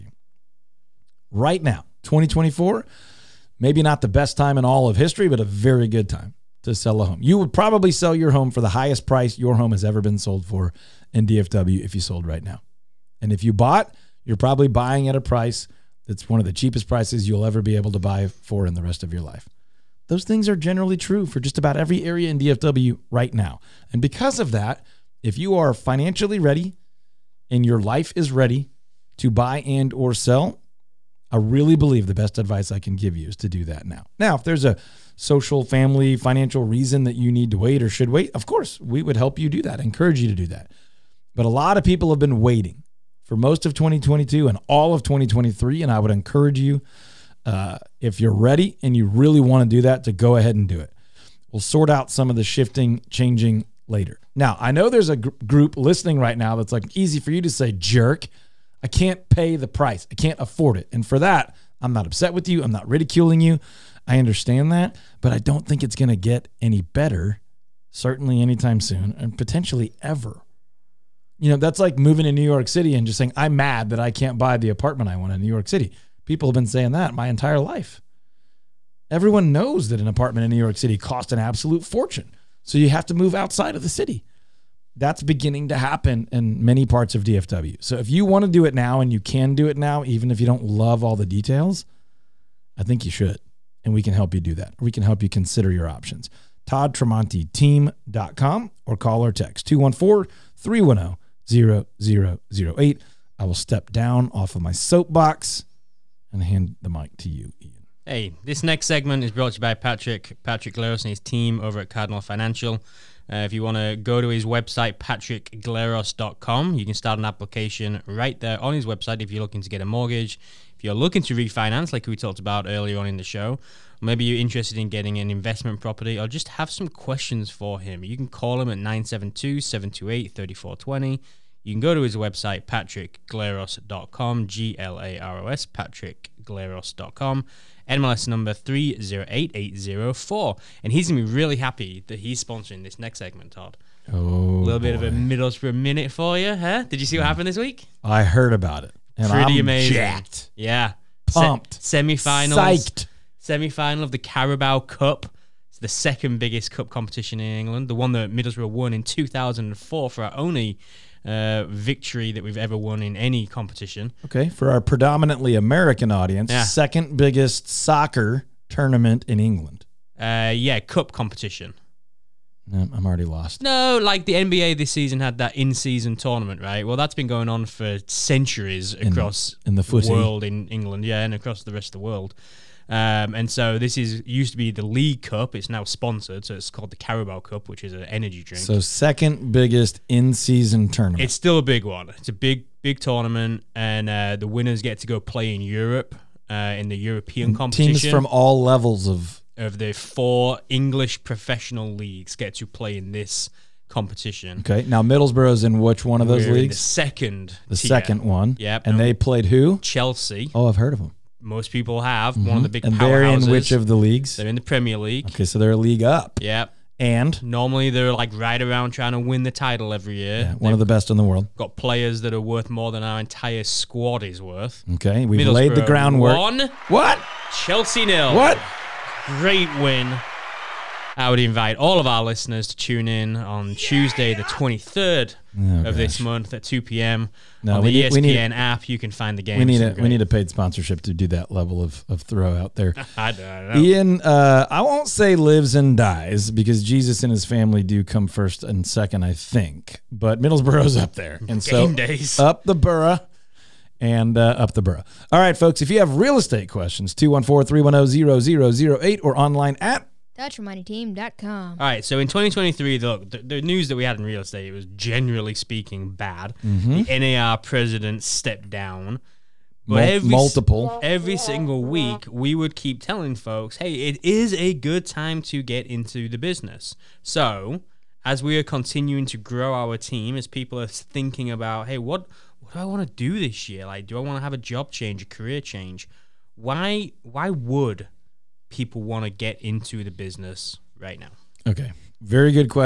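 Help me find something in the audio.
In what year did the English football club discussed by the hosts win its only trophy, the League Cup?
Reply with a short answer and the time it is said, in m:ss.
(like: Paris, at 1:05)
2004, at 2:39.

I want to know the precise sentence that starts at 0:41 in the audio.
But a lot of people have been waiting for most of 2022 and all of 2023.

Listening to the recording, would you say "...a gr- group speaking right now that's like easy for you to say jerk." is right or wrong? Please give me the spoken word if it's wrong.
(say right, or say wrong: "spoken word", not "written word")
wrong: "listening", not "speaking".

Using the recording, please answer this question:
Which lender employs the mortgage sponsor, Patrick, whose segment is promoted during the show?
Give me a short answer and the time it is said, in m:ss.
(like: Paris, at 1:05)
Cardinal Financial, at 1:51.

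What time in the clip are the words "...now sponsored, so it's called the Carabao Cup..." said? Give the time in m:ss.
3:05.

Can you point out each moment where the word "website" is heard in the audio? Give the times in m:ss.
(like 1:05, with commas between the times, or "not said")
1:54, 1:58, 2:12.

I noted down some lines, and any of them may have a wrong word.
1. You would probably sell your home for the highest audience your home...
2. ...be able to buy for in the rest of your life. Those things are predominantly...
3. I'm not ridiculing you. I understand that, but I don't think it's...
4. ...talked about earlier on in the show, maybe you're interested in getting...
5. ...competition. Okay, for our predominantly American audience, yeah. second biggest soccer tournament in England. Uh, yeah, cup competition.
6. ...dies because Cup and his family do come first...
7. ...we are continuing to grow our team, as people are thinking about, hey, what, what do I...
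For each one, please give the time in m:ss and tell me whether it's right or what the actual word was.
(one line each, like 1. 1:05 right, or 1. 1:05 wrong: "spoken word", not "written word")
1. 0:07 wrong: "price", not "audience"
2. 0:17 wrong: "generally", not "predominantly"
3. 1:02 right
4. 2:02 right
5. 2:43 right
6. 4:05 wrong: "Jesus", not "Cup"
7. 4:38 right.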